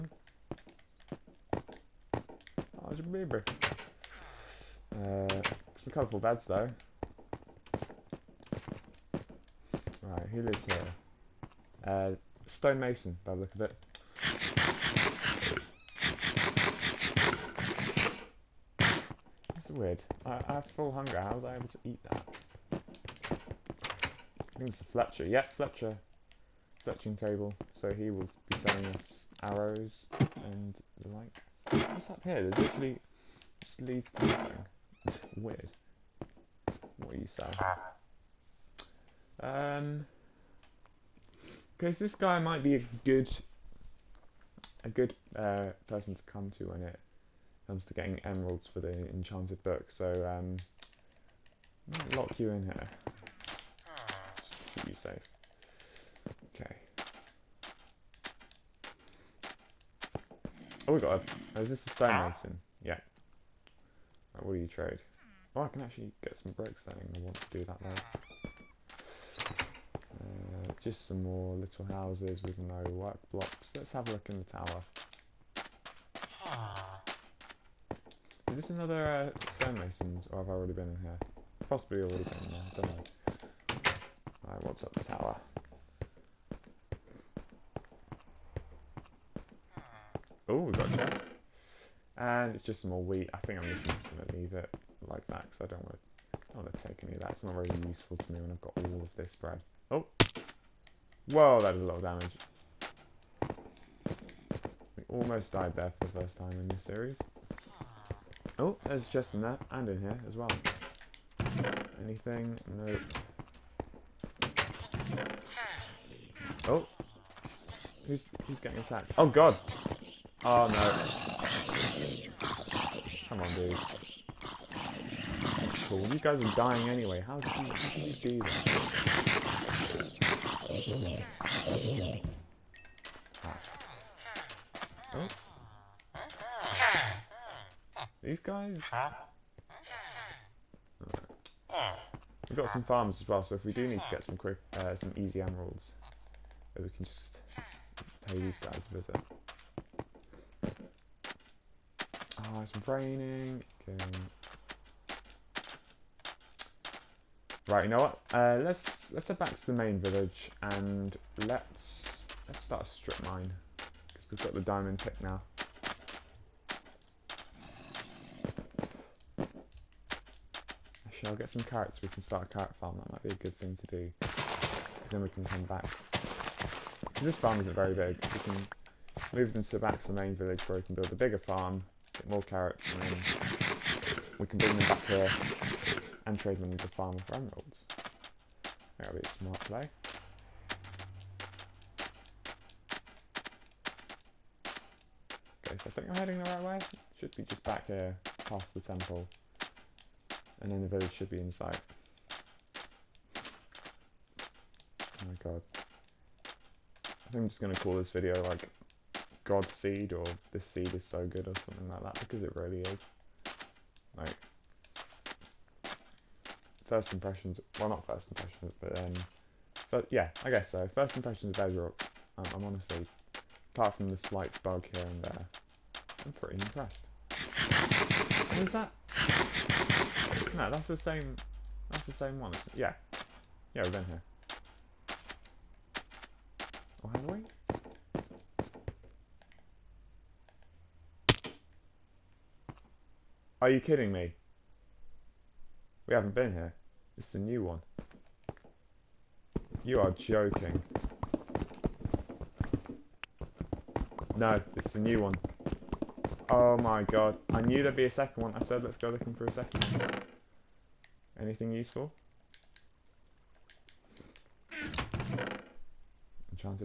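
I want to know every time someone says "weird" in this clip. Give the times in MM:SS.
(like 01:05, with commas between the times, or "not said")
00:19, 00:35.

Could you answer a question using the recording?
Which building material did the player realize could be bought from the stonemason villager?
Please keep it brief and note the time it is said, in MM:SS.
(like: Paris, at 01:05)
Bricks, at 01:06.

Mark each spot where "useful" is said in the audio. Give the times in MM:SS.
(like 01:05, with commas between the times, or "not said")
01:37, 04:21.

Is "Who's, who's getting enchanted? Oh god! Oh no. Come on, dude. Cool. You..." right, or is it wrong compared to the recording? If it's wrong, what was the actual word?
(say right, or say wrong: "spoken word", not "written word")
wrong: "attacked", not "enchanted".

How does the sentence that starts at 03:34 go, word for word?
Like, first impressions, well, not first impressions, but then, um, but yeah, I guess so.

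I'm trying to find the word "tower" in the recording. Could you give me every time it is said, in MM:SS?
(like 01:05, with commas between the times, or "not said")
01:14, 01:25.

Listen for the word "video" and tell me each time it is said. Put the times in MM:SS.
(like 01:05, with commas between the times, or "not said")
03:28.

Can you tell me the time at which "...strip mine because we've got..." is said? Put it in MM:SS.
02:42.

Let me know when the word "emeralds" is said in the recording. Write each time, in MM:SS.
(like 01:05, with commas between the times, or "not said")
00:48, 02:25, 03:07.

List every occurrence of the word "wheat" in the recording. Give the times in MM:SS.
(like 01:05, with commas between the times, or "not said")
01:33.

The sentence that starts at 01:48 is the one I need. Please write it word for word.
Oh, there's just in there and in here as well.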